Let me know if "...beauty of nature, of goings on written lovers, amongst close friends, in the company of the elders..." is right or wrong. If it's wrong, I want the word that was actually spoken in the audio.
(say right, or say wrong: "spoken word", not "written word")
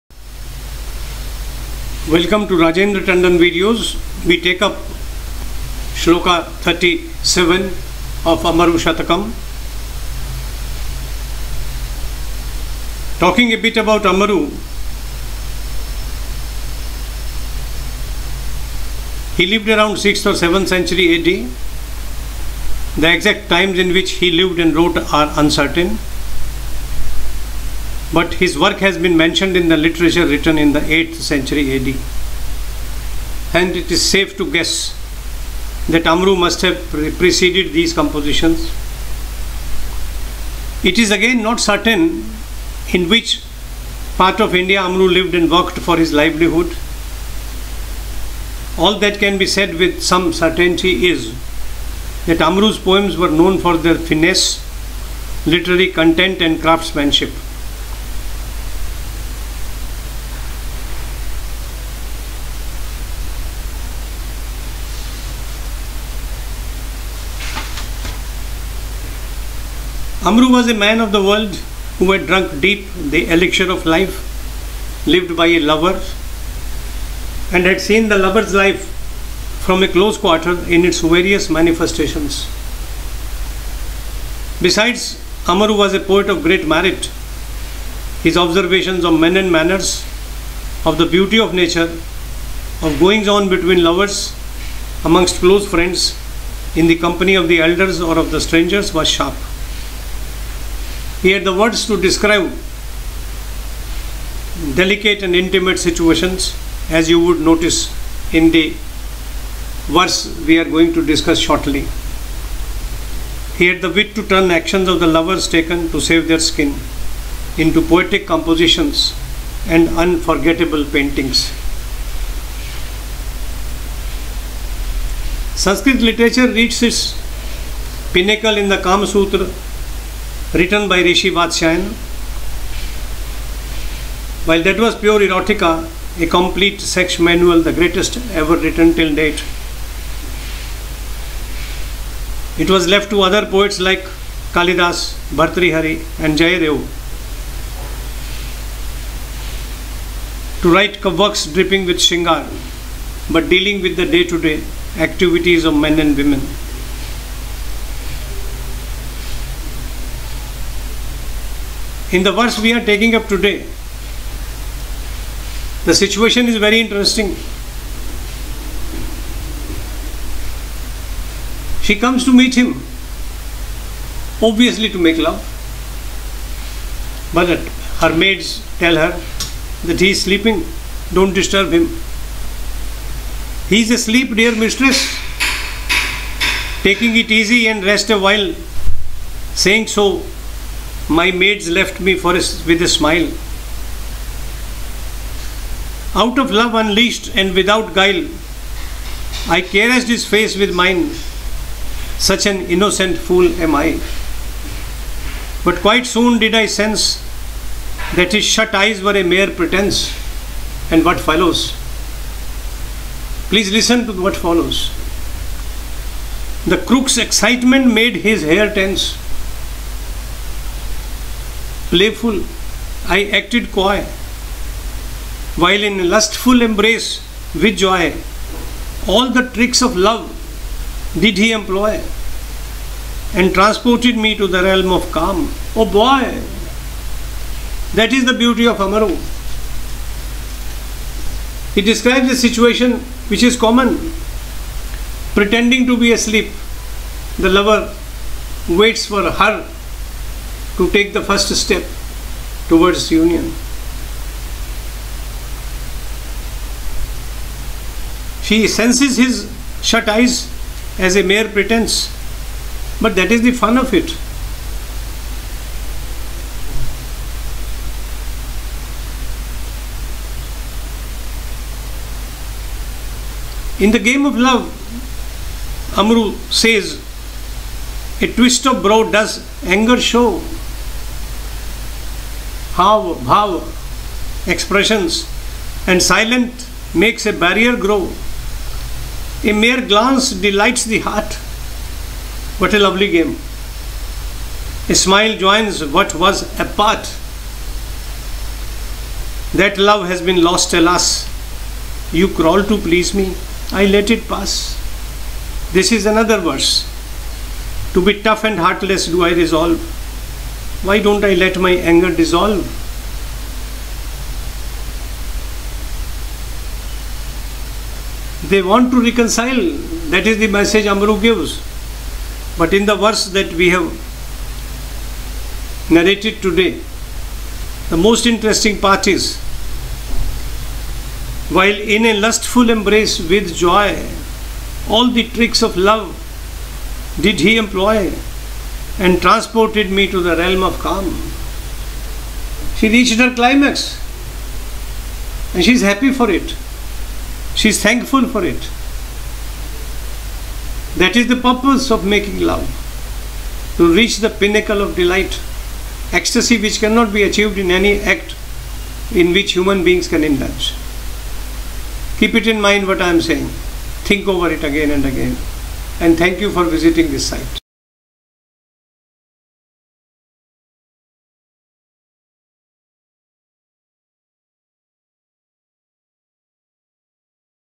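wrong: "between", not "written".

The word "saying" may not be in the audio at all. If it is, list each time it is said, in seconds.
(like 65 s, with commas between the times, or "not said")
189 s, 363 s.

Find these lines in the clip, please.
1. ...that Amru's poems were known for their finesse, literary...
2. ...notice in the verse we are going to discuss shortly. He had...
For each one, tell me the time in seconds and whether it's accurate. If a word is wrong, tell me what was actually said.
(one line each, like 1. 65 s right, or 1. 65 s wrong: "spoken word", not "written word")
1. 52 s right
2. 107 s right.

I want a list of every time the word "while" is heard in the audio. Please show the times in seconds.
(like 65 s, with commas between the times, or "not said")
134 s, 188 s, 225 s, 331 s.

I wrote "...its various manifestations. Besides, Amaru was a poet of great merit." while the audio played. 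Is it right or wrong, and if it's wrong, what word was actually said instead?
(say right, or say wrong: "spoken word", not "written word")
right.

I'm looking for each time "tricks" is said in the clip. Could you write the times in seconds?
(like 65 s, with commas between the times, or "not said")
229 s, 335 s.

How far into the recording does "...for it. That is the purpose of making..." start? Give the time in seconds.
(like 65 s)
348 s.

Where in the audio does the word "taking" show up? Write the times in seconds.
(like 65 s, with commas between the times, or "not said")
162 s, 186 s.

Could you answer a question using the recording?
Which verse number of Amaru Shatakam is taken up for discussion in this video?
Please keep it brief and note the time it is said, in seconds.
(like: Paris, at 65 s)
37, at 5 s.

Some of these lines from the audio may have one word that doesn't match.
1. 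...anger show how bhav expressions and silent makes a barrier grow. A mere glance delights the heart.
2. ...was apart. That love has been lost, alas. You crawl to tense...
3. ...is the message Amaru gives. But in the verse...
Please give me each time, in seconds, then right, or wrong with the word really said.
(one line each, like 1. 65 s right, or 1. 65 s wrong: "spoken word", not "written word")
1. 279 s right
2. 296 s wrong: "please", not "tense"
3. 320 s right.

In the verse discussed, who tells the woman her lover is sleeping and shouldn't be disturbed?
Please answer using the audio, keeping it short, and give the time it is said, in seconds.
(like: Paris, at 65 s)
Her maids, at 178 s.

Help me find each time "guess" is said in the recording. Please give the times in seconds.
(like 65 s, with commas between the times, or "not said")
34 s.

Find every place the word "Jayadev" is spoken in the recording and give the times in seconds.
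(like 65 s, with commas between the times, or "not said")
146 s.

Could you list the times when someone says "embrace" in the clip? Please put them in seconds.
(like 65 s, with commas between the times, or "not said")
226 s, 332 s.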